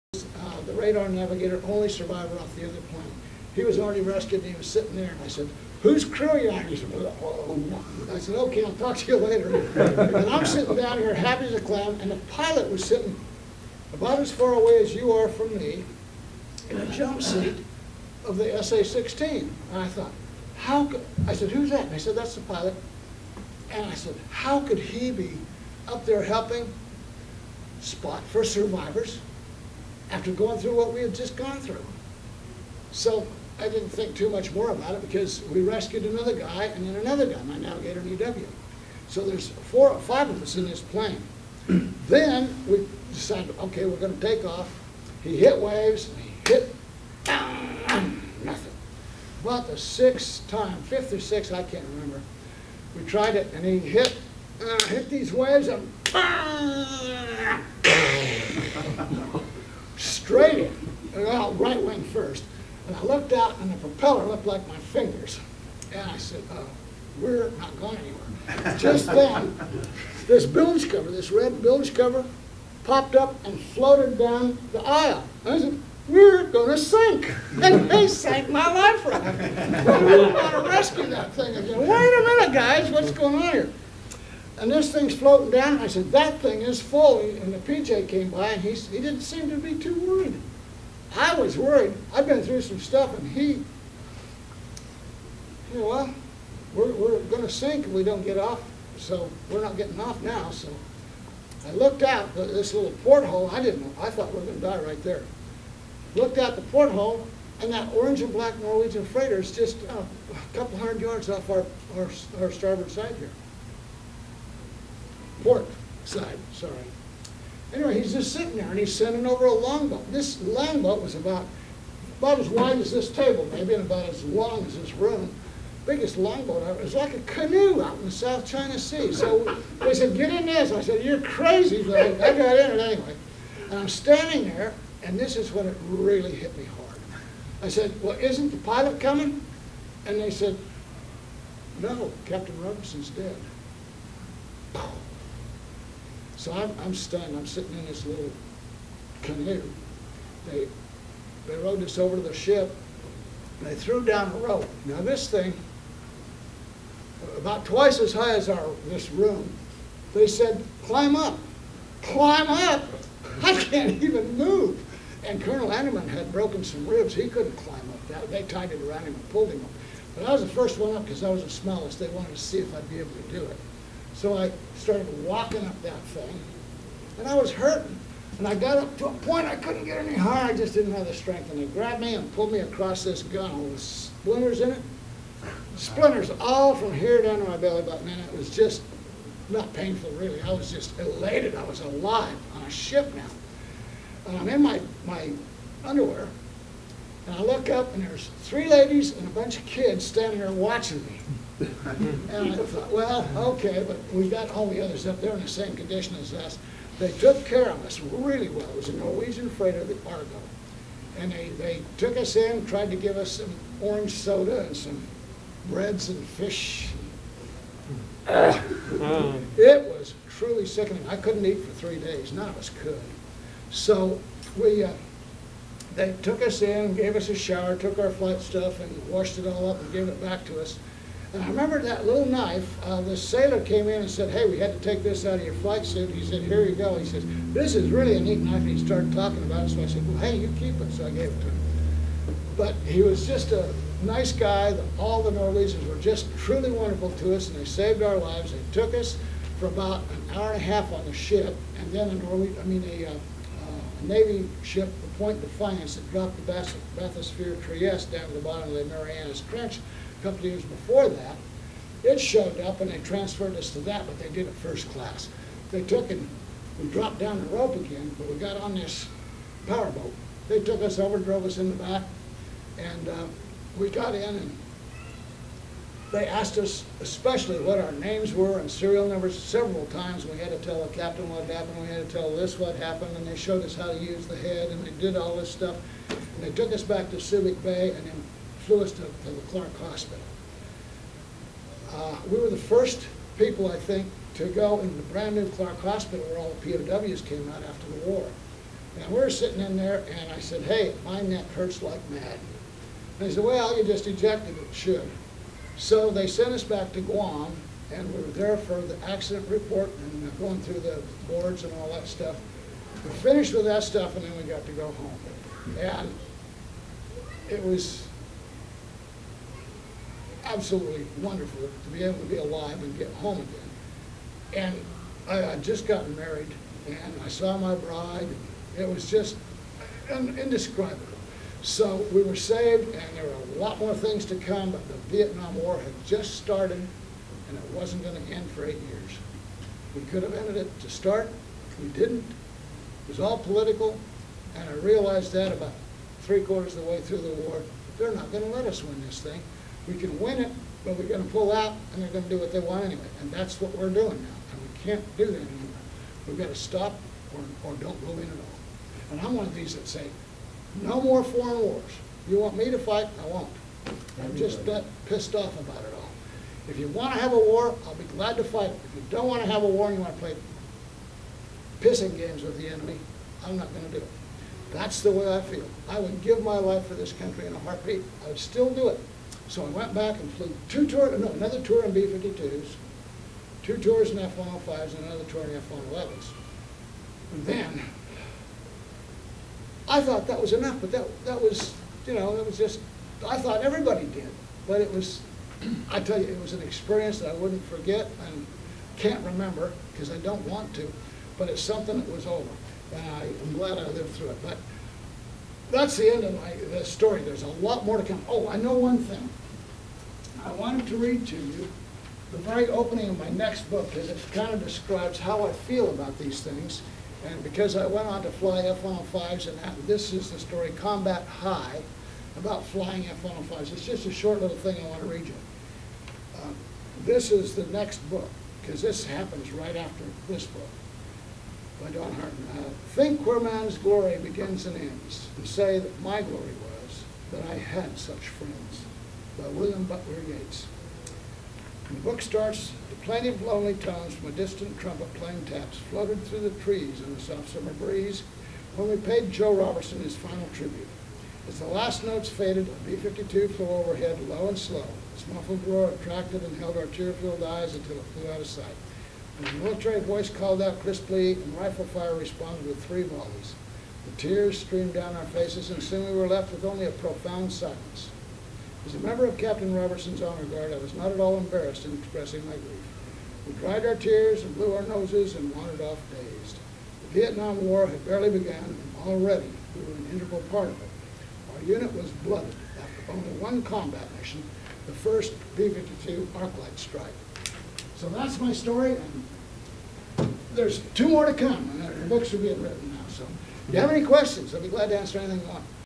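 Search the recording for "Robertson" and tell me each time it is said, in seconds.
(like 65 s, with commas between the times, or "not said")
449 s, 469 s.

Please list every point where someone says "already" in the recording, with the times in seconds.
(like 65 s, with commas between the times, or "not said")
3 s, 479 s.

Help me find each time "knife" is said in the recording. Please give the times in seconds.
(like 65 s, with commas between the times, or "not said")
232 s, 238 s.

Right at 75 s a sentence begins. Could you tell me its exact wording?
I said, we're going to sink.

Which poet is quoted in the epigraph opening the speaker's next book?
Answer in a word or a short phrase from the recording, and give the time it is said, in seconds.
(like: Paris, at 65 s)
William Butler Yeats, at 439 s.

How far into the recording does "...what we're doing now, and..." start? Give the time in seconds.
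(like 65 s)
353 s.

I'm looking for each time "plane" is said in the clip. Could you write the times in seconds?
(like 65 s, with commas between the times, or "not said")
2 s, 40 s.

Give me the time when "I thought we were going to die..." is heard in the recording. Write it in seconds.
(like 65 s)
104 s.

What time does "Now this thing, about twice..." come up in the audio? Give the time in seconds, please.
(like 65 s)
154 s.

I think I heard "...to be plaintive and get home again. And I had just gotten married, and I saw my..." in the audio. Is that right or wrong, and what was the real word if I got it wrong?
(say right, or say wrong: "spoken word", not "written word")
wrong: "alive", not "plaintive".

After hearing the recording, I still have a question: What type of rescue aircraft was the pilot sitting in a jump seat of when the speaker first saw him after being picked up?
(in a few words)
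SA-16.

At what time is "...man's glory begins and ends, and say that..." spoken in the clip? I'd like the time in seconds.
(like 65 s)
433 s.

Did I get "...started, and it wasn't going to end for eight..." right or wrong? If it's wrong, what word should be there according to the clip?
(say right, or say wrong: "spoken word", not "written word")
right.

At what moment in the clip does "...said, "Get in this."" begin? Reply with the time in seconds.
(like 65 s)
129 s.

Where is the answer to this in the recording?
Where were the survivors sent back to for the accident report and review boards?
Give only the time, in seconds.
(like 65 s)
307 s.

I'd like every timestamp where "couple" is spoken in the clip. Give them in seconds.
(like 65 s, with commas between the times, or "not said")
110 s, 260 s.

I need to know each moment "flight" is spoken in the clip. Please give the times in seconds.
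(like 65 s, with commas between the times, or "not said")
228 s, 235 s.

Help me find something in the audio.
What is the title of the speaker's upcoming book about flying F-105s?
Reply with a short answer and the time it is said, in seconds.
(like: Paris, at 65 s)
Combat High, at 420 s.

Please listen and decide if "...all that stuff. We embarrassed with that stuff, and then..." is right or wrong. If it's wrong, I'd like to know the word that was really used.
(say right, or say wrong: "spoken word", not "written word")
wrong: "finished", not "embarrassed".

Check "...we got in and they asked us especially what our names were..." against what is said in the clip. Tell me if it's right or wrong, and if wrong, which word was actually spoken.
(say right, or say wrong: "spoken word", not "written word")
right.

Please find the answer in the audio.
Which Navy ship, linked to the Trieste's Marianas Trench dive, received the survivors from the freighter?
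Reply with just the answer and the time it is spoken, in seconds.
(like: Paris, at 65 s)
Point Defiance, at 255 s.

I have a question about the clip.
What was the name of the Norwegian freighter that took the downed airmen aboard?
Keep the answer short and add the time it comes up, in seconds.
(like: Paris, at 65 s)
Argo, at 209 s.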